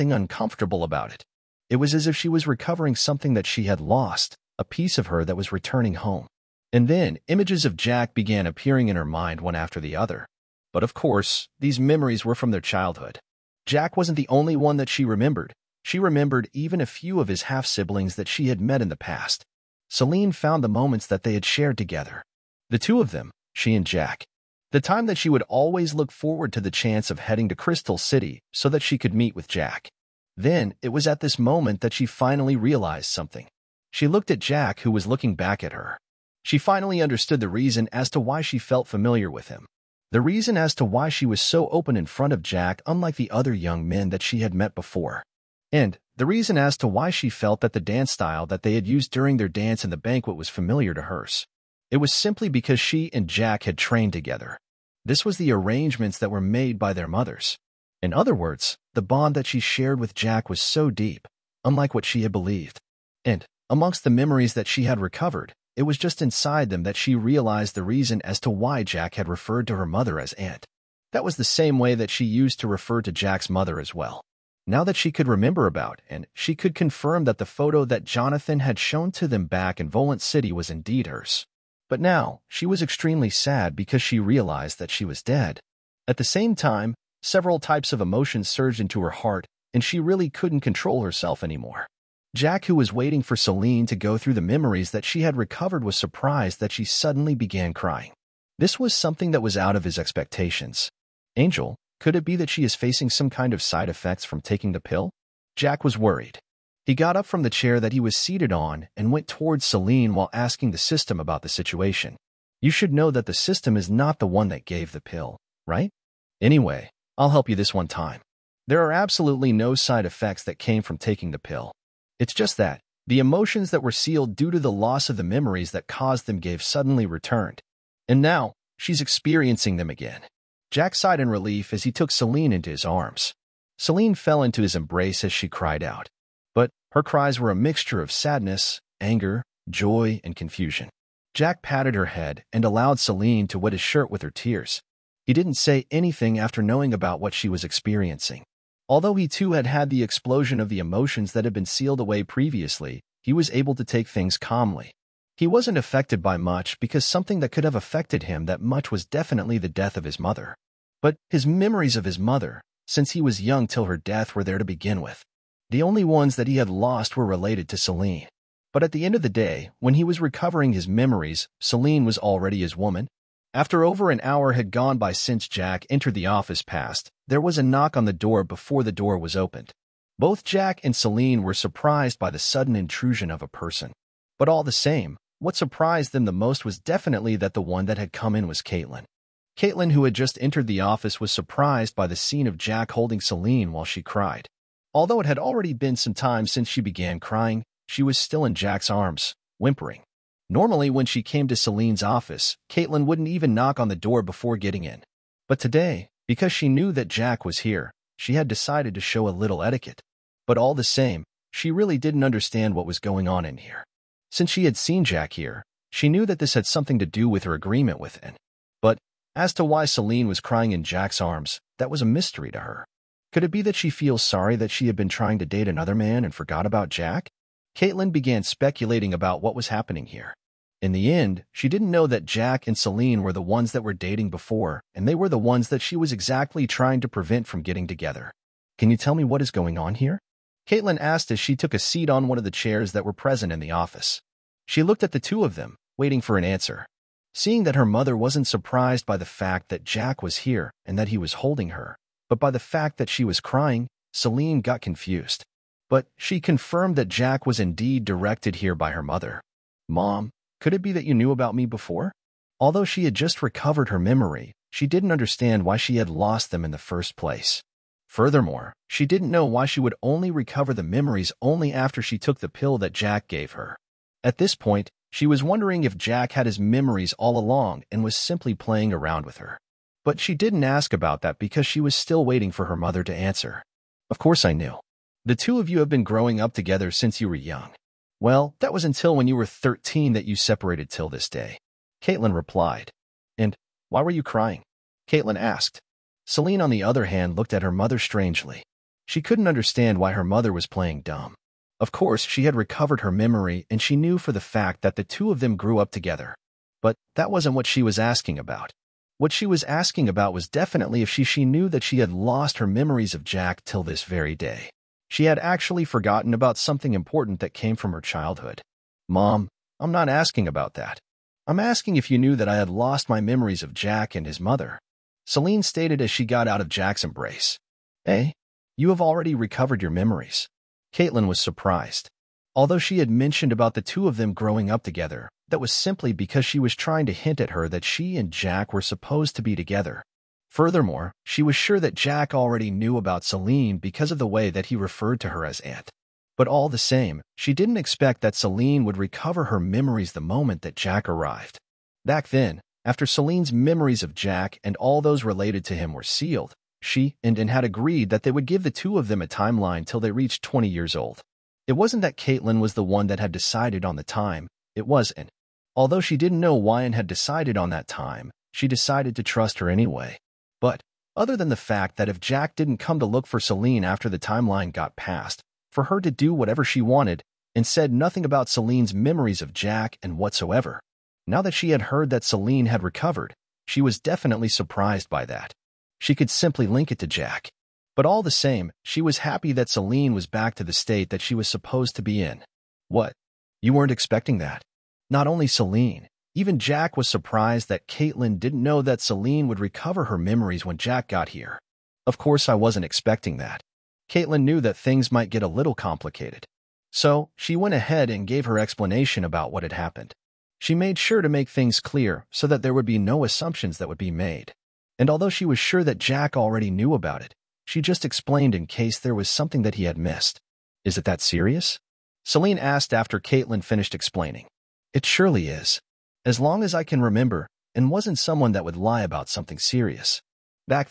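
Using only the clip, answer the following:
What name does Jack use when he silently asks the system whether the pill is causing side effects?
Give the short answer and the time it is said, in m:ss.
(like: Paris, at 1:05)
Angel, at 1:41.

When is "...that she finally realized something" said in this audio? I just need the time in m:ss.
0:31.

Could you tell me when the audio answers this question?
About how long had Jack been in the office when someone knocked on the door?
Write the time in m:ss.
2:53.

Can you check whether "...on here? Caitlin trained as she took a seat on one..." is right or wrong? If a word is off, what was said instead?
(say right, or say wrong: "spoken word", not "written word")
wrong: "asked", not "trained".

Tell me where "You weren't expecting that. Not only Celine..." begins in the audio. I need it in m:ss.
6:33.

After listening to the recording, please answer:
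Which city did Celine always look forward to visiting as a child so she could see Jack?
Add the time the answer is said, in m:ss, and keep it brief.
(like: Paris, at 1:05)
Crystal City, at 0:27.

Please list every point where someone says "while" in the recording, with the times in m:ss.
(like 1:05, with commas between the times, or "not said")
1:50, 3:13.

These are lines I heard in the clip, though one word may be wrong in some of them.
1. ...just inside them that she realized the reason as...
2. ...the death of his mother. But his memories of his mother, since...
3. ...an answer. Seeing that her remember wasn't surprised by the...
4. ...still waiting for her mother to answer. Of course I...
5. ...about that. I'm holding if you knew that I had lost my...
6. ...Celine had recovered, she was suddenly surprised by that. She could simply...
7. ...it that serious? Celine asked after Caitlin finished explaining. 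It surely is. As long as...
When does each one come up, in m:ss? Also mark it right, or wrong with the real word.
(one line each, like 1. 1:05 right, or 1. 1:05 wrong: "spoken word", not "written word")
1. 1:05 right
2. 2:39 right
3. 4:06 wrong: "mother", not "remember"
4. 4:41 right
5. 5:20 wrong: "asking", not "holding"
6. 6:22 wrong: "definitely", not "suddenly"
7. 7:00 right.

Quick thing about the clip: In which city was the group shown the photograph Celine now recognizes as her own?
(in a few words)
Volant City.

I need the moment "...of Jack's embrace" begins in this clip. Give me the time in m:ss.
5:26.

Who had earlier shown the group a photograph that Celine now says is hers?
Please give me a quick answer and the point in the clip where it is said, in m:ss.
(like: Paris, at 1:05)
Jonathan, at 1:18.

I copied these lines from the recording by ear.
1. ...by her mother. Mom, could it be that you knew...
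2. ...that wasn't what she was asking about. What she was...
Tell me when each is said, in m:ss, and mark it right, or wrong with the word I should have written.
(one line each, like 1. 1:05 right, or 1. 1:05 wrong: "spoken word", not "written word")
1. 4:18 right
2. 5:07 right.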